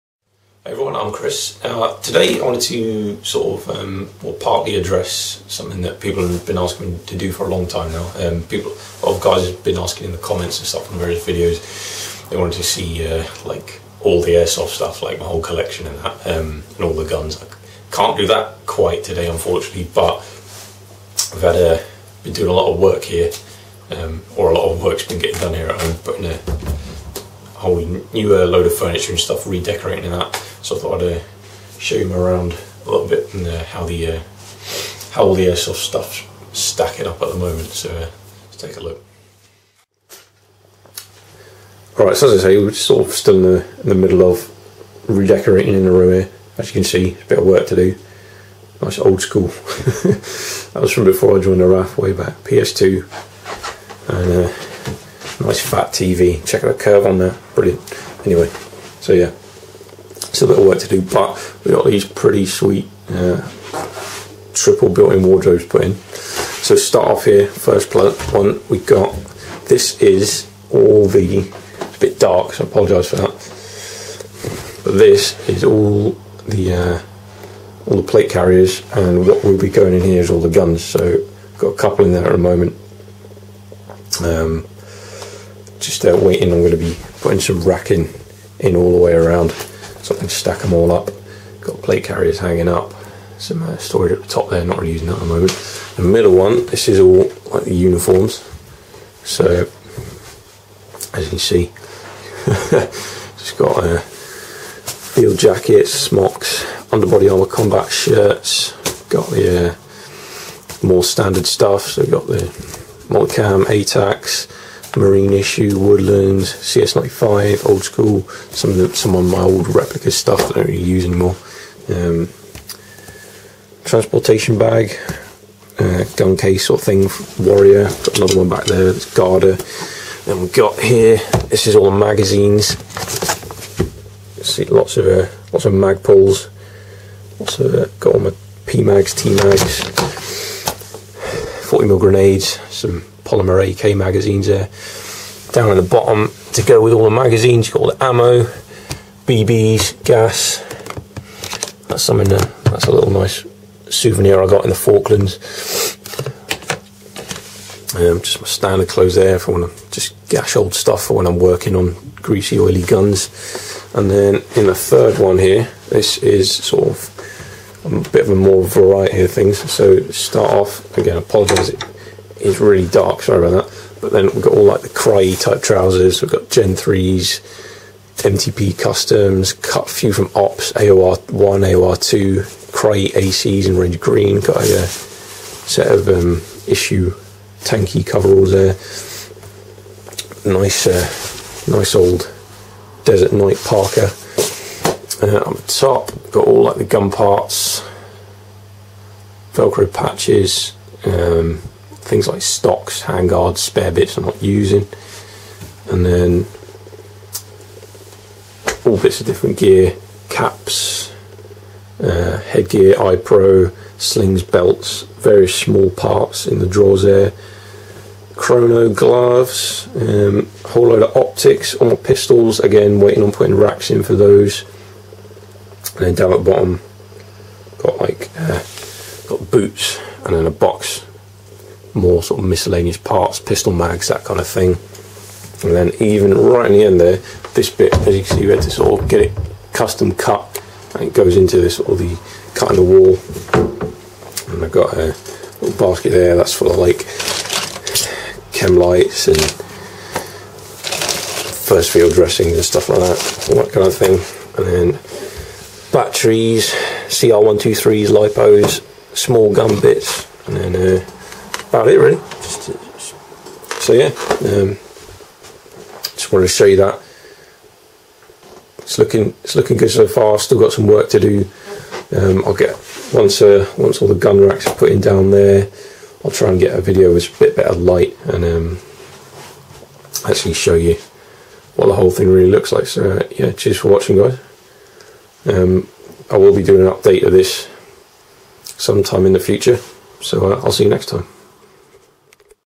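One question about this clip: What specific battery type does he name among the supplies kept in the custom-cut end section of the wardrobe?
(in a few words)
CR123s.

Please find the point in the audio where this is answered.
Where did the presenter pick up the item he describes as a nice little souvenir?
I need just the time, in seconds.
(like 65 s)
154 s.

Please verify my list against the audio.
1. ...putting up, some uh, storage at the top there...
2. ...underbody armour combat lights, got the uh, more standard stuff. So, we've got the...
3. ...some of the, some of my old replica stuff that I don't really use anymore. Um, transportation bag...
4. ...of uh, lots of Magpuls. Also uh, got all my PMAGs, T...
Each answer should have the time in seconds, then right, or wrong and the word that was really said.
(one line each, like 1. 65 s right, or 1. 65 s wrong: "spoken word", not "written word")
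1. 92 s wrong: "hanging", not "putting"
2. 106 s wrong: "shirts", not "lights"
3. 118 s right
4. 134 s right.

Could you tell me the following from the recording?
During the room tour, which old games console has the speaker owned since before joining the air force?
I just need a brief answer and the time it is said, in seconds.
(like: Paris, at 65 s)
PS2, at 52 s.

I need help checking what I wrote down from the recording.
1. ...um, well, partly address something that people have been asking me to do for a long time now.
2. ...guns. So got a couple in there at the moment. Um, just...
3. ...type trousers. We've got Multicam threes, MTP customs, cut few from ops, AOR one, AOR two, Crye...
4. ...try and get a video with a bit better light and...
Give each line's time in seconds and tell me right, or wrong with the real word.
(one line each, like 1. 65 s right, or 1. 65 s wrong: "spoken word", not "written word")
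1. 3 s right
2. 80 s right
3. 175 s wrong: "Gen", not "Multicam"
4. 276 s right.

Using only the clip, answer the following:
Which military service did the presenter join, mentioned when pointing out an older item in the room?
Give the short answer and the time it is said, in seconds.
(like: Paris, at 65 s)
RAF, at 51 s.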